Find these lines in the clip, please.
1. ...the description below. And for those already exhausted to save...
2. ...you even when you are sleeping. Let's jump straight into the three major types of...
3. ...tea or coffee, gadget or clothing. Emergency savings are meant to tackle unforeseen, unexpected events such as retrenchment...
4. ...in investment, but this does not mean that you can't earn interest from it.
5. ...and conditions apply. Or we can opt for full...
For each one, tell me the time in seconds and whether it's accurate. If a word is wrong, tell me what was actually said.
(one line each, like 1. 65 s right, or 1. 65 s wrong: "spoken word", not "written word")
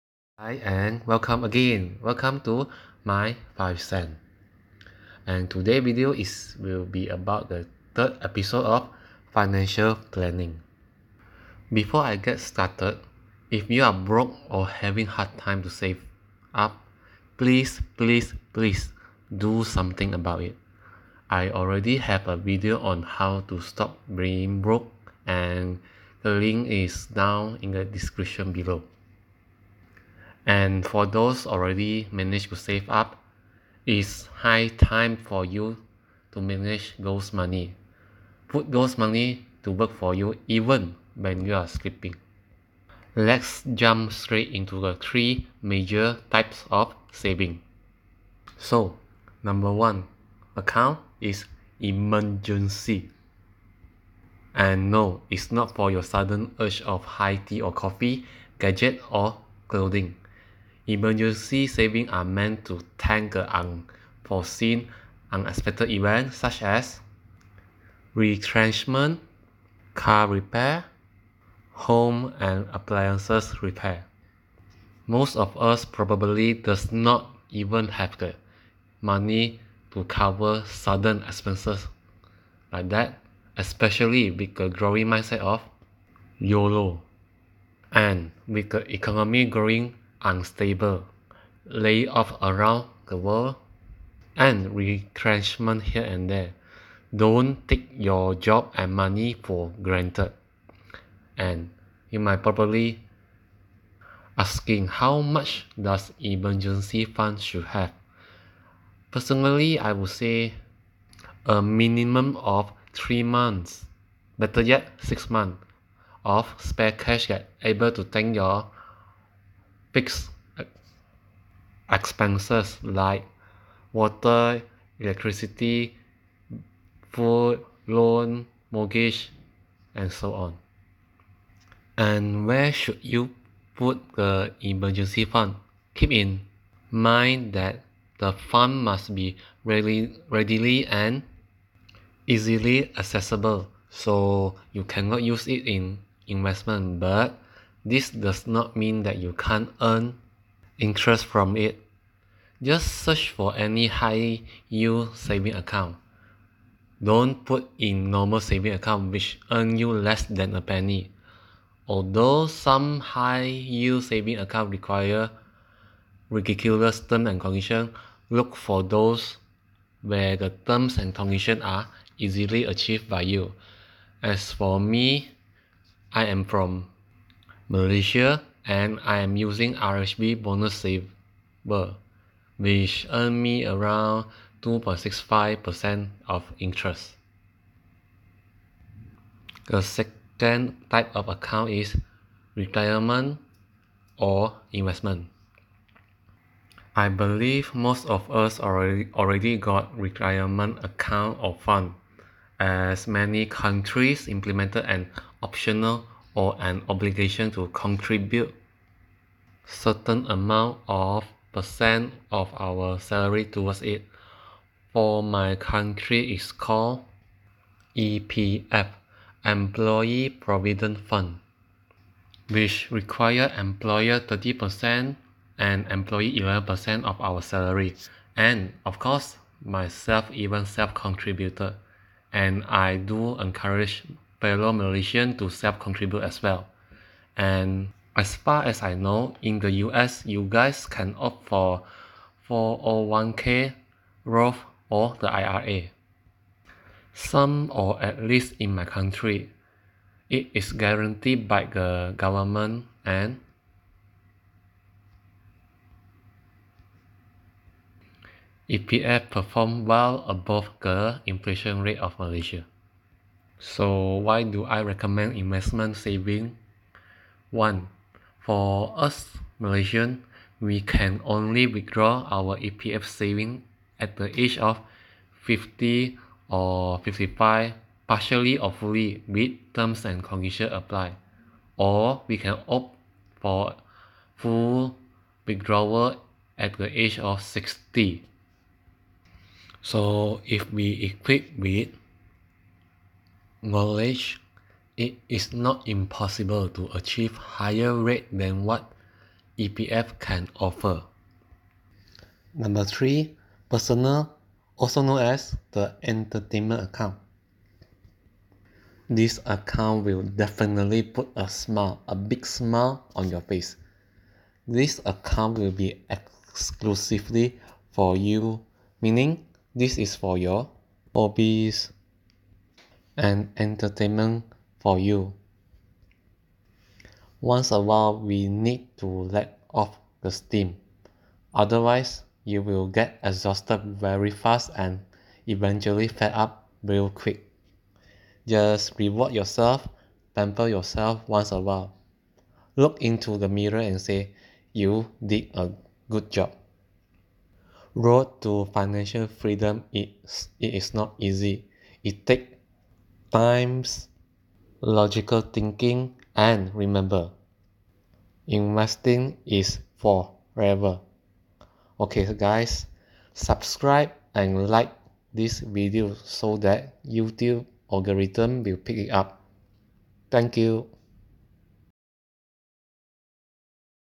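1. 27 s wrong: "managed", not "exhausted"
2. 40 s right
3. 57 s right
4. 145 s right
5. 280 s right.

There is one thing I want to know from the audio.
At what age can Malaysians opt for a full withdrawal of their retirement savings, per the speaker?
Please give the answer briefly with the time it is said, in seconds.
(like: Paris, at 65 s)
60, at 287 s.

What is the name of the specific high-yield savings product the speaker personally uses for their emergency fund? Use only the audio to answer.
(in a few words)
RHB Bonus Saver.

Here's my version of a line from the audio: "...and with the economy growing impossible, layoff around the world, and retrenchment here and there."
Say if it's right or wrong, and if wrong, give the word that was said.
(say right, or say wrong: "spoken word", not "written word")
wrong: "unstable", not "impossible".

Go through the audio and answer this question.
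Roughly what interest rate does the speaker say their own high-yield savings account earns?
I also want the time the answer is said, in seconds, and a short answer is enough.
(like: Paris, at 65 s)
2.65%, at 184 s.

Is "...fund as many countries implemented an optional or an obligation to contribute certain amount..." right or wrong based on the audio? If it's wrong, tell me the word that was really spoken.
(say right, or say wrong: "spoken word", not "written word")
right.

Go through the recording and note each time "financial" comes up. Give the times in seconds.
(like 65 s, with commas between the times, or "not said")
9 s, 348 s.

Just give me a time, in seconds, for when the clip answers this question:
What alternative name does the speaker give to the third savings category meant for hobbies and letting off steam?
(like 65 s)
306 s.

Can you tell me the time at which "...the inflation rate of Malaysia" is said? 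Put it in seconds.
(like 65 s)
260 s.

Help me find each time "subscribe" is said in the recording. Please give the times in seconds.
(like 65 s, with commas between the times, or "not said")
363 s.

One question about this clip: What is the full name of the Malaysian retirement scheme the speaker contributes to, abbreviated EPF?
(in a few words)
Employee Provident Fund.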